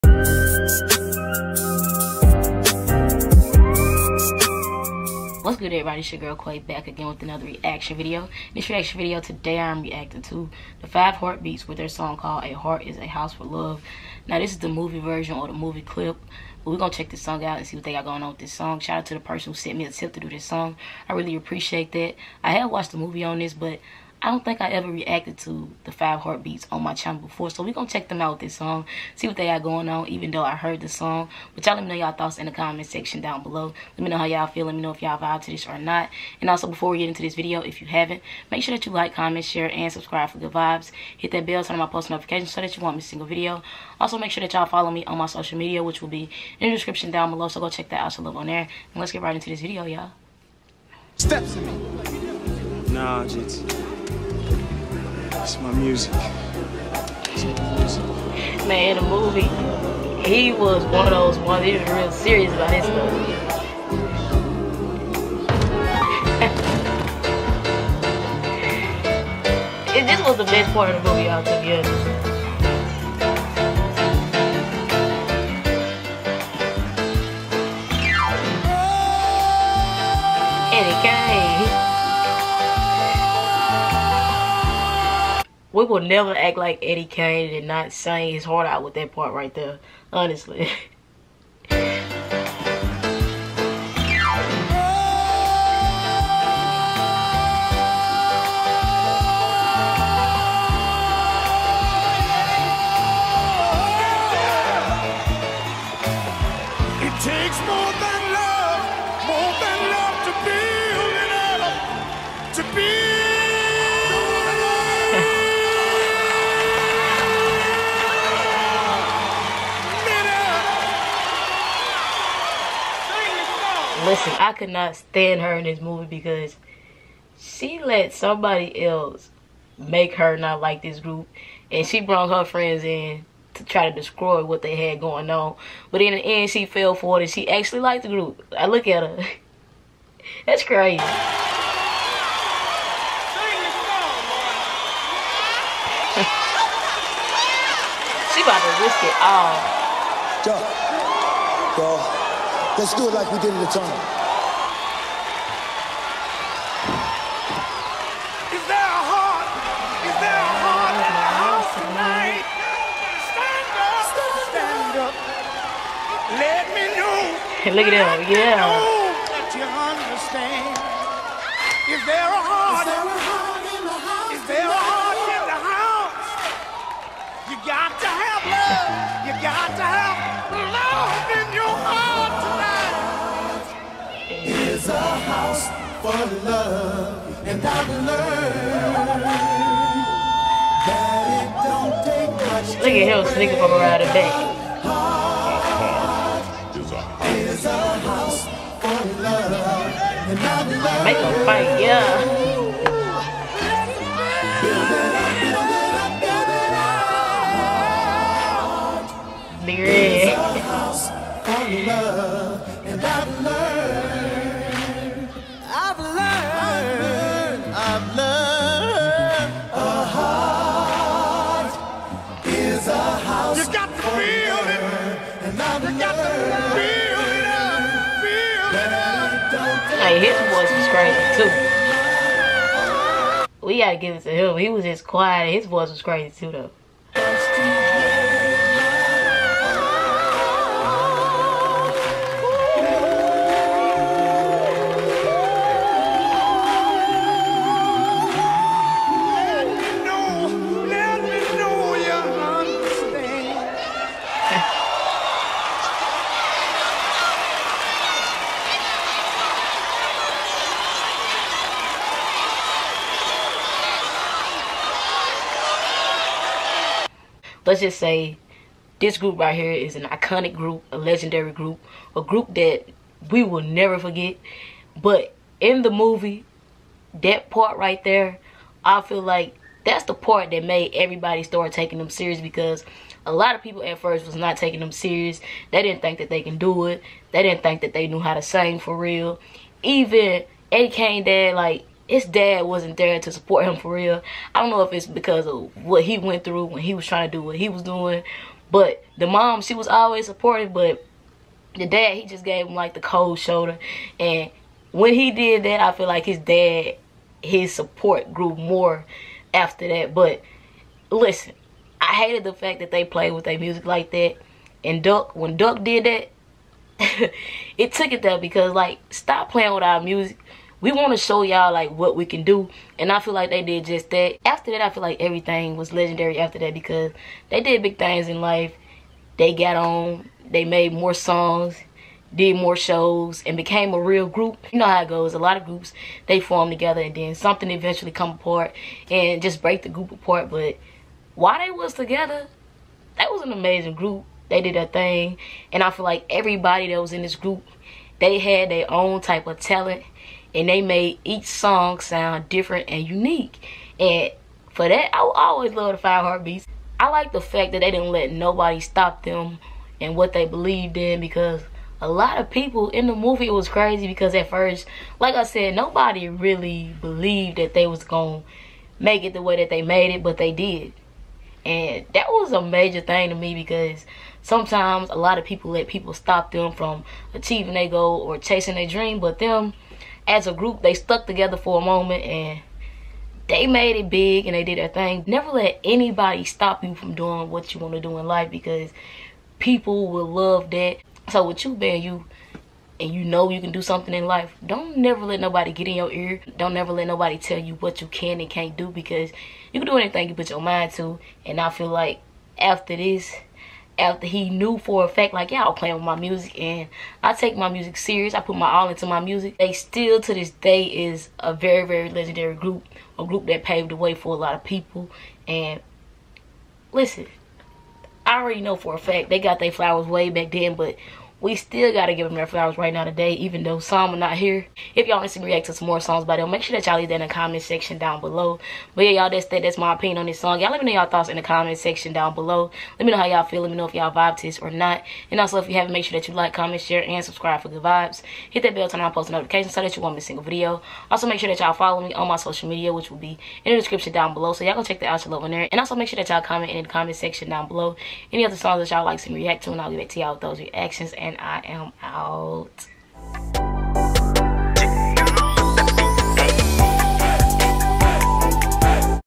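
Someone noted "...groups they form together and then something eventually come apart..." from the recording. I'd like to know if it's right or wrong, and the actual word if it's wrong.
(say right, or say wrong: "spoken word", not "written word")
right.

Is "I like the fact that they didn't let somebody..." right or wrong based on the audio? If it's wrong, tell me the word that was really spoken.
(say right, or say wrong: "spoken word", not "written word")
wrong: "nobody", not "somebody".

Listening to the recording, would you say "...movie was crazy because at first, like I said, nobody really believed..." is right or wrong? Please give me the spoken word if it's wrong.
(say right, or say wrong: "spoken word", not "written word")
right.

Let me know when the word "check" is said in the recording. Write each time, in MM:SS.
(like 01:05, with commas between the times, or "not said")
00:16, 00:27, 00:47, 07:24.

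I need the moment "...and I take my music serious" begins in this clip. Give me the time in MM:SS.
06:46.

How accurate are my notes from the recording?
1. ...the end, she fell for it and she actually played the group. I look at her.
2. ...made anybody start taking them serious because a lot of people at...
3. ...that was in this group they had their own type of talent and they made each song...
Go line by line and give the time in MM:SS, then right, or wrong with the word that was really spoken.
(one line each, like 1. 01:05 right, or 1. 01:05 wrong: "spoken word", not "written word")
1. 02:16 wrong: "liked", not "played"
2. 04:40 wrong: "everybody", not "anybody"
3. 05:46 right.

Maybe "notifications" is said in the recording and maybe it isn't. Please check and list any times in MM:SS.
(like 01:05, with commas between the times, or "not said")
00:42, 07:19.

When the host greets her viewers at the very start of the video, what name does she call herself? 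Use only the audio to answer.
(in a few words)
Quay.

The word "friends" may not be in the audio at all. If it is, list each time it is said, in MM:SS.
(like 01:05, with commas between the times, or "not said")
02:12.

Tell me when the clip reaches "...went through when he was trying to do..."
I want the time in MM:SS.
04:56.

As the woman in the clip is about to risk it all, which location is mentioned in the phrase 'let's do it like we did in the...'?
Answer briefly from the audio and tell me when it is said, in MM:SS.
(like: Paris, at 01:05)
the tunnel, at 02:33.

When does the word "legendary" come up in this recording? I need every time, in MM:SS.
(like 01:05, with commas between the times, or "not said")
04:30, 05:25, 06:52.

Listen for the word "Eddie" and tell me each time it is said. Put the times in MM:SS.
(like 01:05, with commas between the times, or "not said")
01:26, 04:50.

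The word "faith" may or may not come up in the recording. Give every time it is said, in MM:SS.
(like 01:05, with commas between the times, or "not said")
not said.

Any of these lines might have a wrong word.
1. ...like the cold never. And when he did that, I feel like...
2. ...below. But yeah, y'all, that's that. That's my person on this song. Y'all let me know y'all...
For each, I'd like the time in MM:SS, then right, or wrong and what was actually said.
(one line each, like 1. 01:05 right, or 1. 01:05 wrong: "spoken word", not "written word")
1. 05:02 wrong: "shoulder", not "never"
2. 07:08 wrong: "opinion", not "person".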